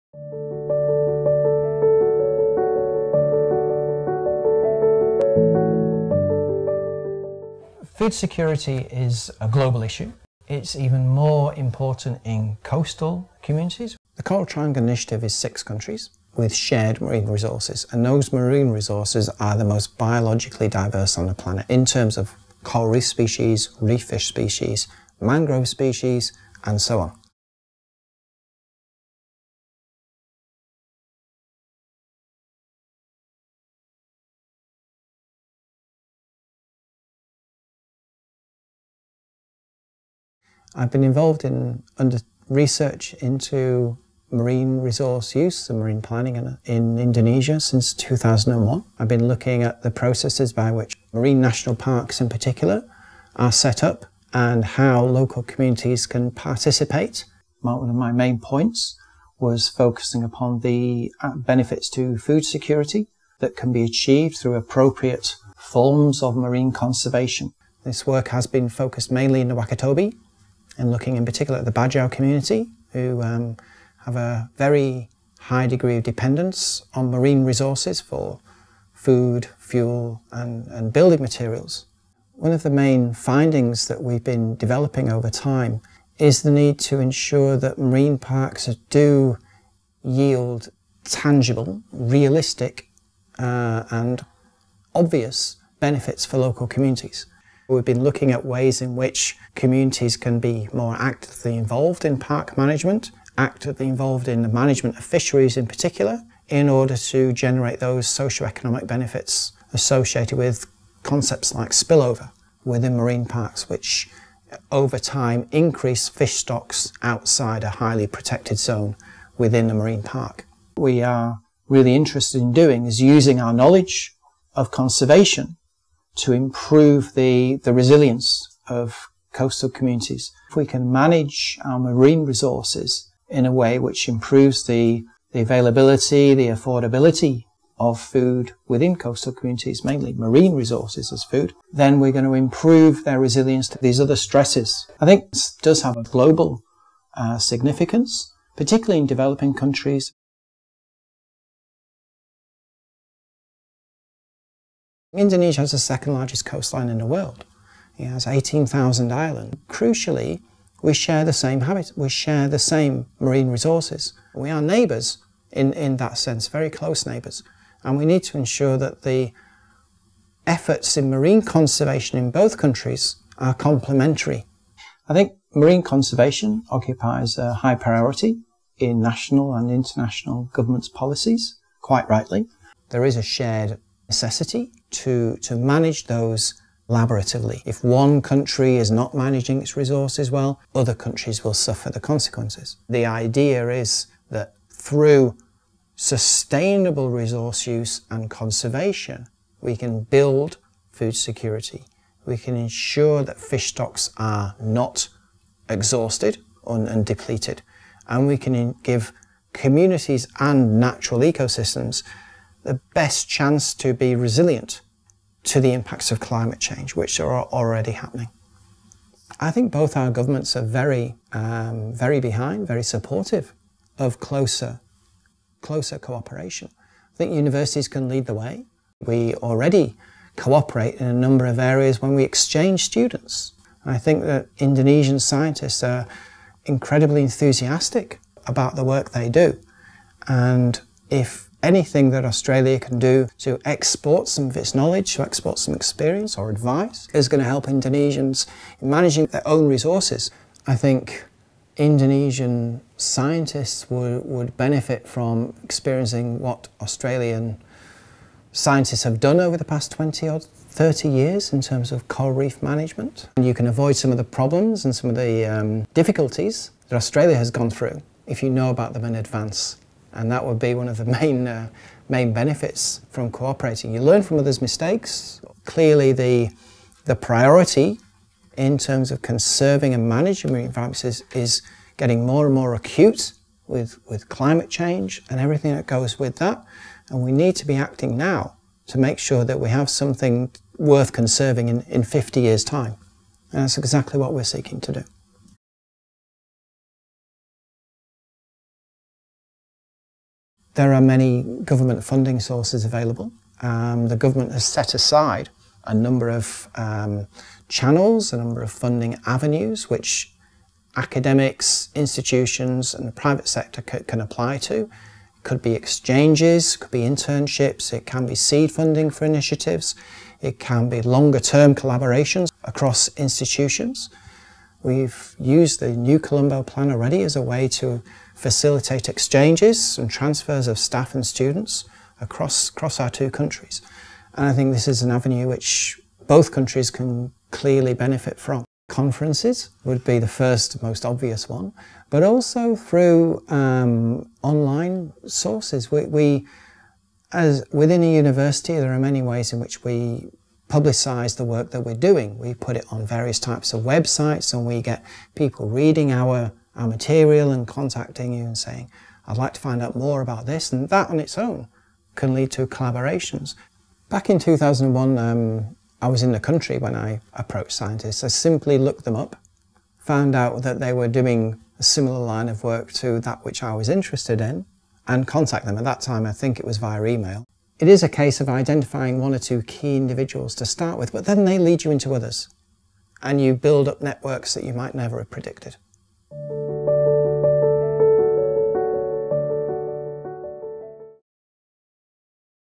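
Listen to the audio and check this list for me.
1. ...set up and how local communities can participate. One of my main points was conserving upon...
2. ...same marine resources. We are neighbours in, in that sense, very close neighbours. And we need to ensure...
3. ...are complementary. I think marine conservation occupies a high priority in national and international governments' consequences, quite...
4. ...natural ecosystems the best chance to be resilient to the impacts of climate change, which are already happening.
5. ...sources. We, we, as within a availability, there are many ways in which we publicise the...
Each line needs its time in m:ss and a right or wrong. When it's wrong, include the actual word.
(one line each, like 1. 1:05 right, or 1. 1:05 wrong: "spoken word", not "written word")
1. 0:53 wrong: "focusing", not "conserving"
2. 2:42 right
3. 2:53 wrong: "policies", not "consequences"
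4. 3:30 right
5. 5:45 wrong: "university", not "availability".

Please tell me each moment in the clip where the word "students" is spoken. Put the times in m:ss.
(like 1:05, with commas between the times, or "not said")
3:52, 5:31.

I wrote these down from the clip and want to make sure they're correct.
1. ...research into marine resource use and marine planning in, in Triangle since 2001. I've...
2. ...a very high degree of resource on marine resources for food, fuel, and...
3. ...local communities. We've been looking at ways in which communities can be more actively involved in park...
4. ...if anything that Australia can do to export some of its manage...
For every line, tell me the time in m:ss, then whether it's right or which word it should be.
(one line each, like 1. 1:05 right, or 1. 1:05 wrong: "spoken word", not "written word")
1. 0:42 wrong: "Indonesia", not "Triangle"
2. 1:14 wrong: "dependence", not "resource"
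3. 1:36 right
4. 4:01 wrong: "knowledge", not "manage".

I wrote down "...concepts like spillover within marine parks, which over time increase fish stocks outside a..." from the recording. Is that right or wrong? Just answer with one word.
right.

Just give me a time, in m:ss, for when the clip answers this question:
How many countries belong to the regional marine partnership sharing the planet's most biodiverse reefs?
0:15.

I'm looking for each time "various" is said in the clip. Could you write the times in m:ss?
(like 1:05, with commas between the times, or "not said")
5:53.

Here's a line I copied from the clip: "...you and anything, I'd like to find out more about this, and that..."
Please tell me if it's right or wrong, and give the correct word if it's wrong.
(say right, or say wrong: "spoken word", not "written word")
wrong: "saying", not "anything".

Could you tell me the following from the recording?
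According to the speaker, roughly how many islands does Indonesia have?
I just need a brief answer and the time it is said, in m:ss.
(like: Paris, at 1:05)
18,000, at 2:38.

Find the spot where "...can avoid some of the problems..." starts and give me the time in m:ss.
4:23.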